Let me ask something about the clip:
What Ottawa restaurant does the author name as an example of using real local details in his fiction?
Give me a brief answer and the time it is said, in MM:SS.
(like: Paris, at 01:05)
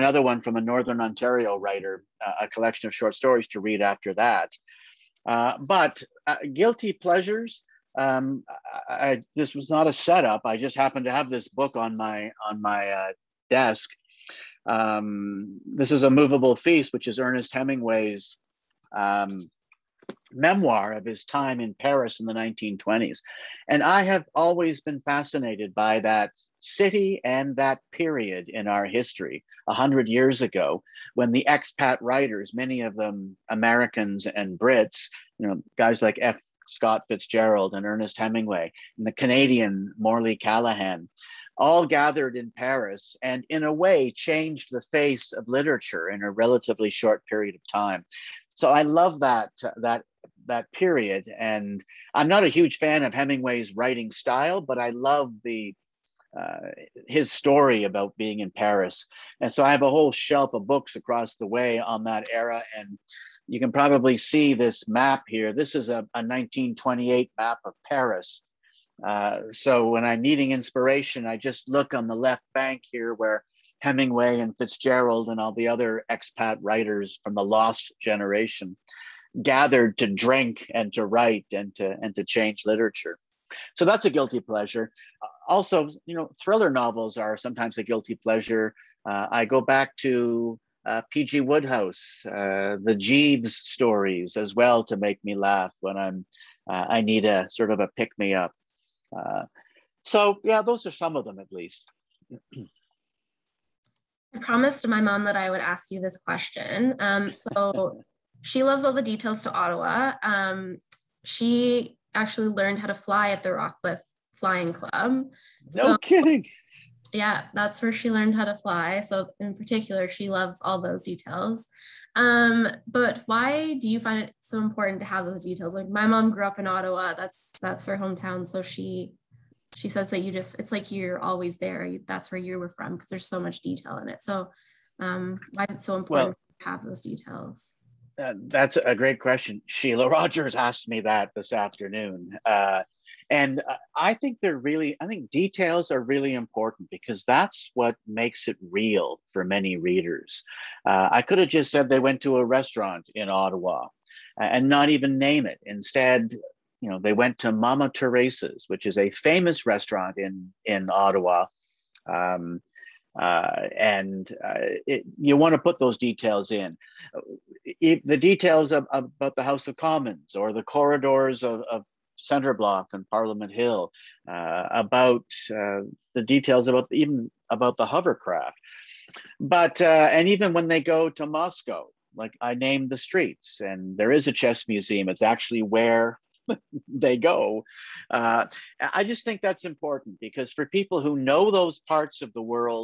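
Mamma Teresa's, at 02:37.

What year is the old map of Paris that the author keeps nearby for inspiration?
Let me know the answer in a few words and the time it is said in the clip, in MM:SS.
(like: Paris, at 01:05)
1928, at 01:06.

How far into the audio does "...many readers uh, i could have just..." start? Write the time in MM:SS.
02:29.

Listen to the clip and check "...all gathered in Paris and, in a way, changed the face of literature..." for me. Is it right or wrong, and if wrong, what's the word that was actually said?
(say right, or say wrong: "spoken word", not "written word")
right.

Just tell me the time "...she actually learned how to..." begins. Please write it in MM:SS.
01:51.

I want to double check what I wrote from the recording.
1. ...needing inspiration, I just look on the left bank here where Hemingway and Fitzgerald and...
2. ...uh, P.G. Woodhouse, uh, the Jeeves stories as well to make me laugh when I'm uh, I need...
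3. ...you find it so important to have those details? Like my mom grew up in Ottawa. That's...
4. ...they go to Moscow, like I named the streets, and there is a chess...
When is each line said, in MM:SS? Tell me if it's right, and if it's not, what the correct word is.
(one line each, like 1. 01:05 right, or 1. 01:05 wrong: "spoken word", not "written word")
1. 01:10 right
2. 01:30 right
3. 02:03 right
4. 03:00 right.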